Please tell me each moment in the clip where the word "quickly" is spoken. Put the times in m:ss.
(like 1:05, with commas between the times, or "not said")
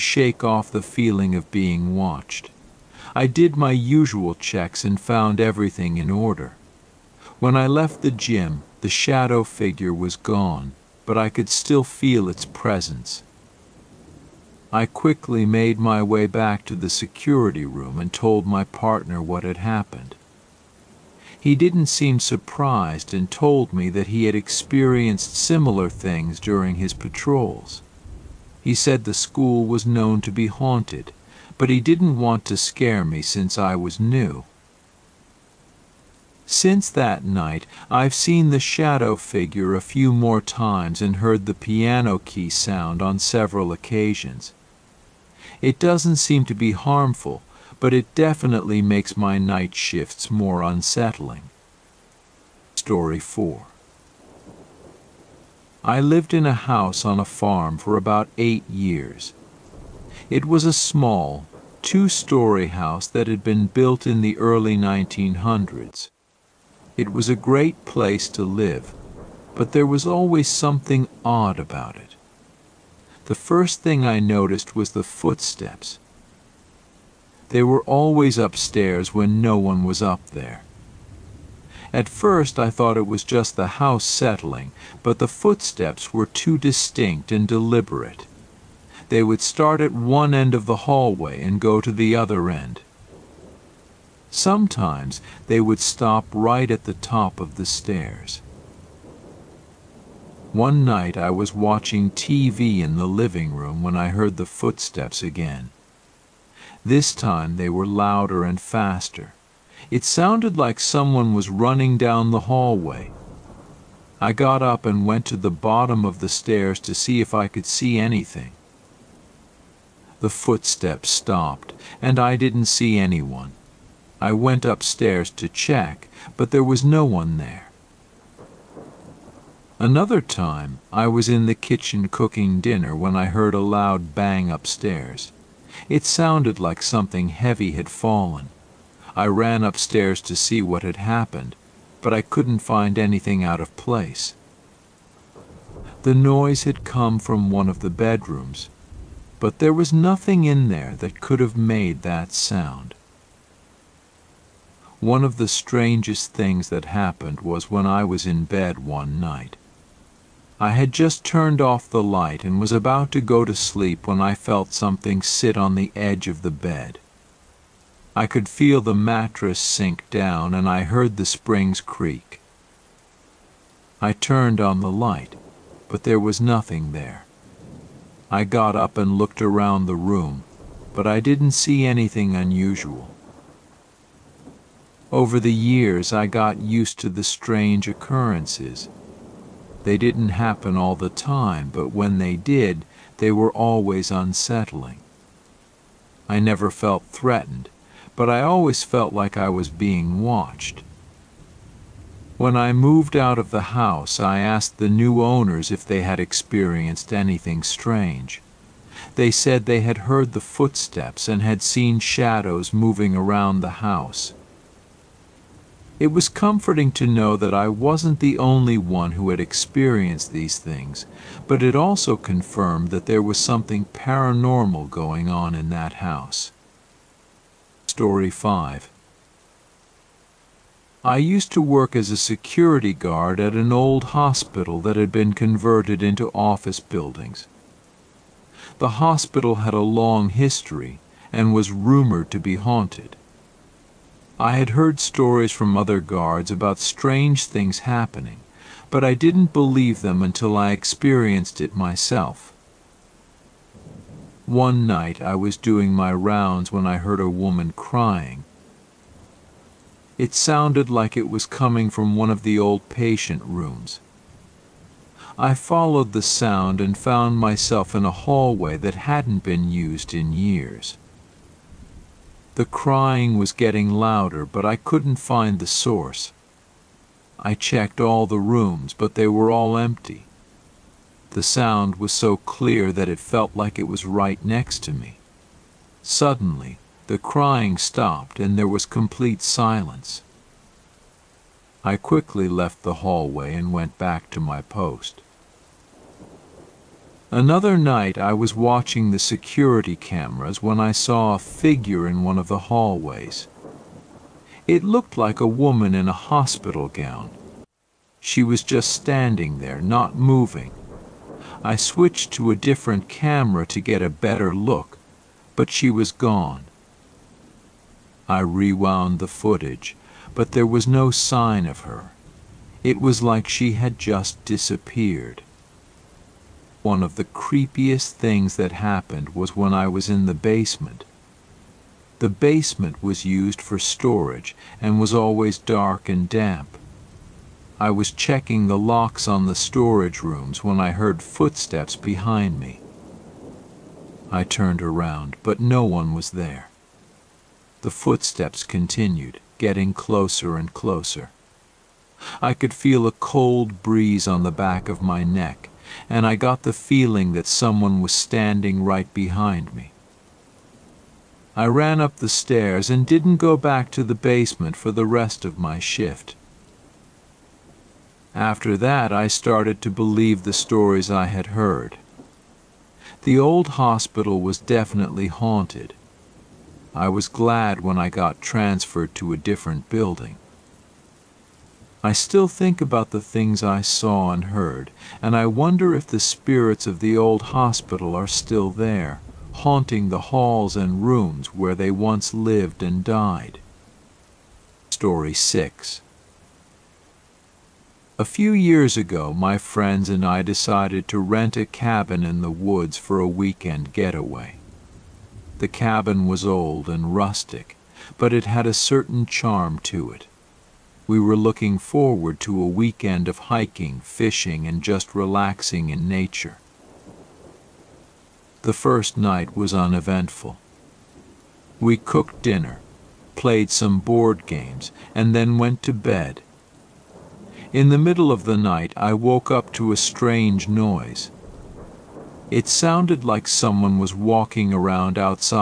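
0:14, 4:51.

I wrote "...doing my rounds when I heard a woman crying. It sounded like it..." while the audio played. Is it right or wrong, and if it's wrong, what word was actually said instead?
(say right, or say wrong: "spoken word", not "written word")
right.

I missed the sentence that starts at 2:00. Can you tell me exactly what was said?
The footsteps stopped, and I didn't see anyone.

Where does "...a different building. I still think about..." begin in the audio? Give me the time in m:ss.
6:19.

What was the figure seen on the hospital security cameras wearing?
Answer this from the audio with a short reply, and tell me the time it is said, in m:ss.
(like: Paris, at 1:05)
hospital gown, at 5:06.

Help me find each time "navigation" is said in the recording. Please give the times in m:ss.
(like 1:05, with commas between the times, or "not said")
not said.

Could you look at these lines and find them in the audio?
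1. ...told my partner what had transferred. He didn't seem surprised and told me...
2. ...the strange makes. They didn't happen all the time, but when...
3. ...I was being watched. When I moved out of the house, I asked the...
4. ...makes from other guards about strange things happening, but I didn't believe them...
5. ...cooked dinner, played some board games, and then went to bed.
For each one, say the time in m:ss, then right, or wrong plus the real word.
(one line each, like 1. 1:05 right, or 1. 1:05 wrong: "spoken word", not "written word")
1. 0:18 wrong: "happened", not "transferred"
2. 3:07 wrong: "occurrences", not "makes"
3. 3:19 right
4. 4:05 wrong: "stories", not "makes"
5. 7:01 right.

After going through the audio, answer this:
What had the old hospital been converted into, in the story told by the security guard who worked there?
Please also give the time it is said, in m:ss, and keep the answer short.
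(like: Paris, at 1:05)
office buildings, at 3:56.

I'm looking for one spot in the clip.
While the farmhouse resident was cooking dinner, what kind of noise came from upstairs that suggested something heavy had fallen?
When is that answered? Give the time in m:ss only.
2:13.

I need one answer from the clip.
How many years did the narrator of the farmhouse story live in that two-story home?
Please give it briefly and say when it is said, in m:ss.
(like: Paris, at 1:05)
8, at 0:58.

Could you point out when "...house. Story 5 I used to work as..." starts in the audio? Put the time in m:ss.
3:45.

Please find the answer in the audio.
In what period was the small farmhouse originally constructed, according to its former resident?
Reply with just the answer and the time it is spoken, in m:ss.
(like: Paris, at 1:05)
early 1900s, at 1:04.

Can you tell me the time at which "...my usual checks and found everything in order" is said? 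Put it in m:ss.
0:03.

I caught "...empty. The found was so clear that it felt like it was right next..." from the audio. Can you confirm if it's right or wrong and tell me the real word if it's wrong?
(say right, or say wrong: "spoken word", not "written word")
wrong: "sound", not "found".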